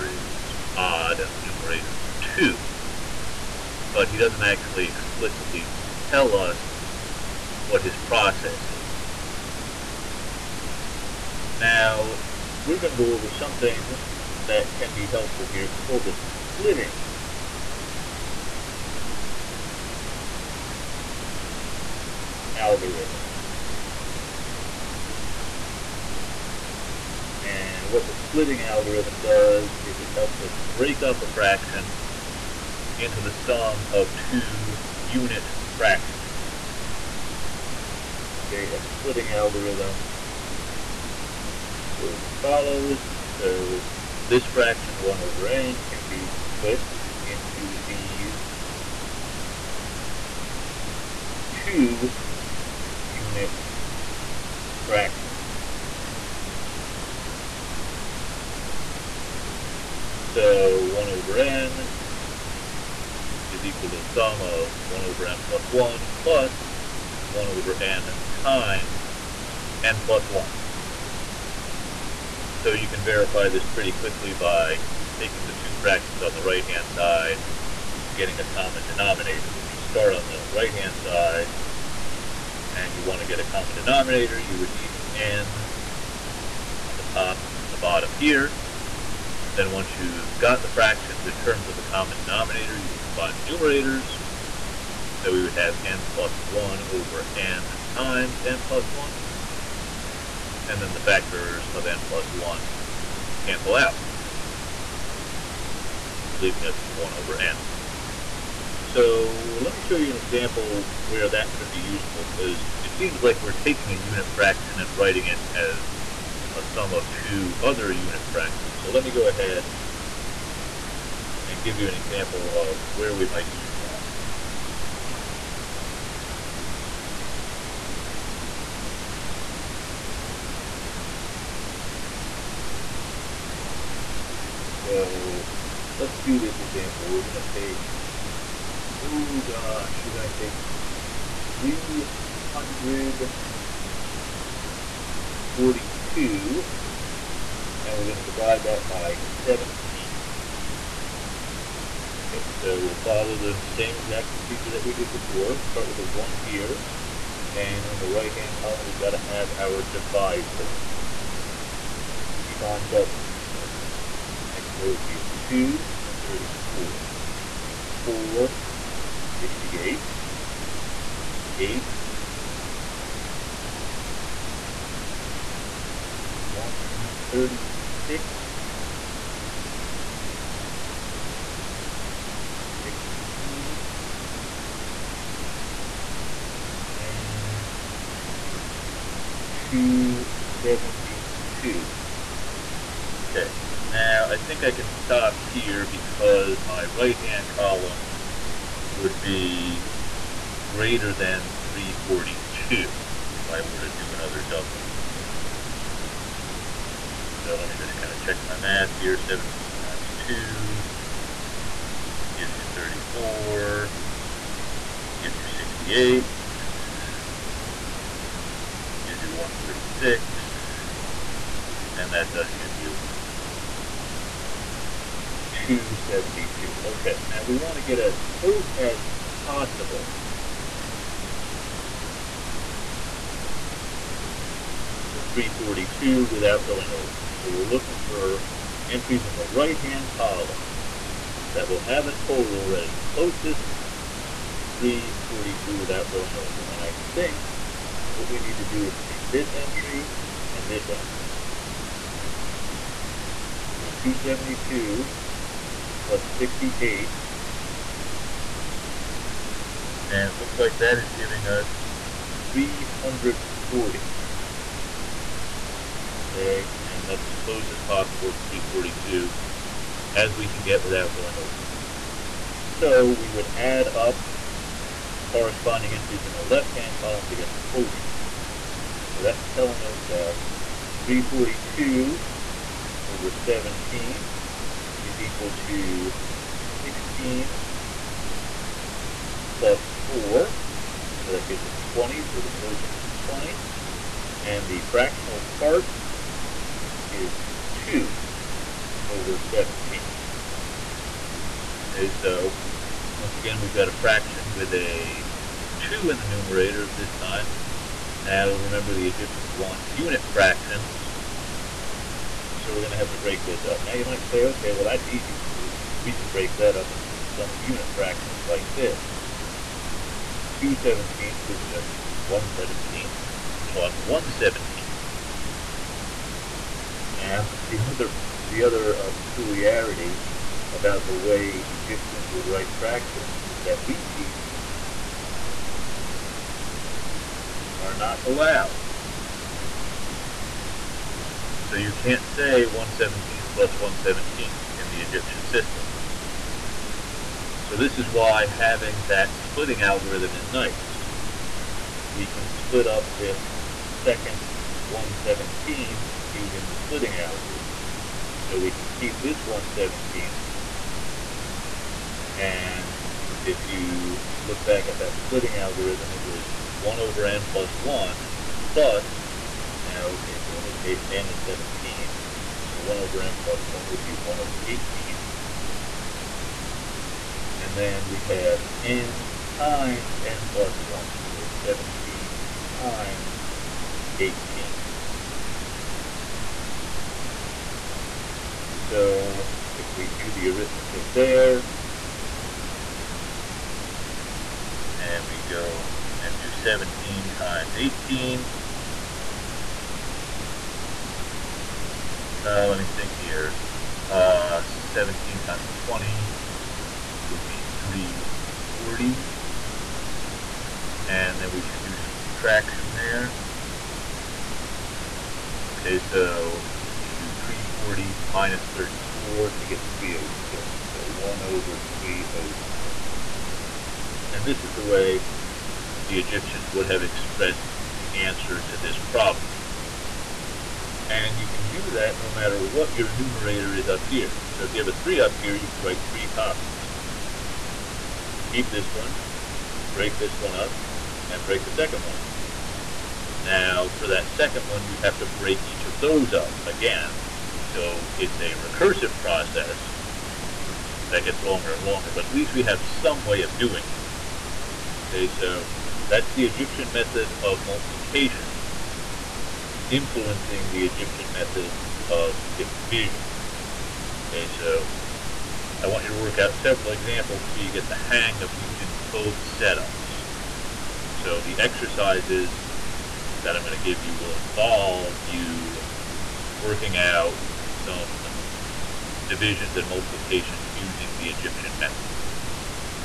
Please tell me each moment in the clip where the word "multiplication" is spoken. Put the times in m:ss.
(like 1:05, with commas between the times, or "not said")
7:37, 7:59.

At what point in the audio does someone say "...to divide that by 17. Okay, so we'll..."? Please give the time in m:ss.
2:28.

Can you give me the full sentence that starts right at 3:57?
So we're looking for entries in the right-hand column that will have a total that is closest to 342 without going over.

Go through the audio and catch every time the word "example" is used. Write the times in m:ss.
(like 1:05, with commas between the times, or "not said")
1:50, 2:01, 2:16, 7:46.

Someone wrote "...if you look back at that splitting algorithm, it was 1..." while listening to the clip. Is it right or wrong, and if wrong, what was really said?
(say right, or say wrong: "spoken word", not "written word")
right.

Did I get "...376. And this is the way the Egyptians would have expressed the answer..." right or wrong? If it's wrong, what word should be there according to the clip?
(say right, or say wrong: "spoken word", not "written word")
wrong: "306", not "376".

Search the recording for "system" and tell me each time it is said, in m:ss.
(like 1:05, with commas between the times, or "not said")
5:45.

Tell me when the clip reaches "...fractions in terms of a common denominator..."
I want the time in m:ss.
1:30.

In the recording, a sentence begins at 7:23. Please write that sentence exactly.
Now, for that second one, you'd have to break each of those up again.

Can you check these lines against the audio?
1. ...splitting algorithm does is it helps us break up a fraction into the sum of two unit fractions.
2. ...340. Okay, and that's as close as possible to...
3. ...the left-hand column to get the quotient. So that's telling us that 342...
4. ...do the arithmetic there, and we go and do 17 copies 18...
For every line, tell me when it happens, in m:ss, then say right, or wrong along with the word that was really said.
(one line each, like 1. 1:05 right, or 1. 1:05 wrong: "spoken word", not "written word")
1. 0:28 right
2. 4:22 right
3. 4:36 right
4. 6:30 wrong: "times", not "copies".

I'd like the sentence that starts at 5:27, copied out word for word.
Now, the other, the other uh, peculiarity about the way Egyptians would write fractions is that repeats are not allowed.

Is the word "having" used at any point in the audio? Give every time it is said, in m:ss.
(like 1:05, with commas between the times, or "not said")
5:48.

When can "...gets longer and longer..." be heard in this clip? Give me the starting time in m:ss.
7:31.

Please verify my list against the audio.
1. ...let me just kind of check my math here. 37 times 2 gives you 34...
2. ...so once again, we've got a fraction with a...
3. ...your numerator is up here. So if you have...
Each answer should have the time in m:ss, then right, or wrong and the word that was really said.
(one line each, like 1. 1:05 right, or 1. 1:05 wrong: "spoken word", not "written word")
1. 3:27 wrong: "17", not "37"
2. 5:02 right
3. 7:12 right.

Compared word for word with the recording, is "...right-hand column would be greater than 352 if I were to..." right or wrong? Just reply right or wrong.
wrong.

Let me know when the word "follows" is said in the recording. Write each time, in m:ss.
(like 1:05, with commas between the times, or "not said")
0:42, 2:33.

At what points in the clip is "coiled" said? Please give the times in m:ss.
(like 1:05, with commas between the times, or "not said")
not said.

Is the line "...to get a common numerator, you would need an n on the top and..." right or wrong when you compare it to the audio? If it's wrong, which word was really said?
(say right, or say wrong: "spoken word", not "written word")
wrong: "denominator", not "numerator".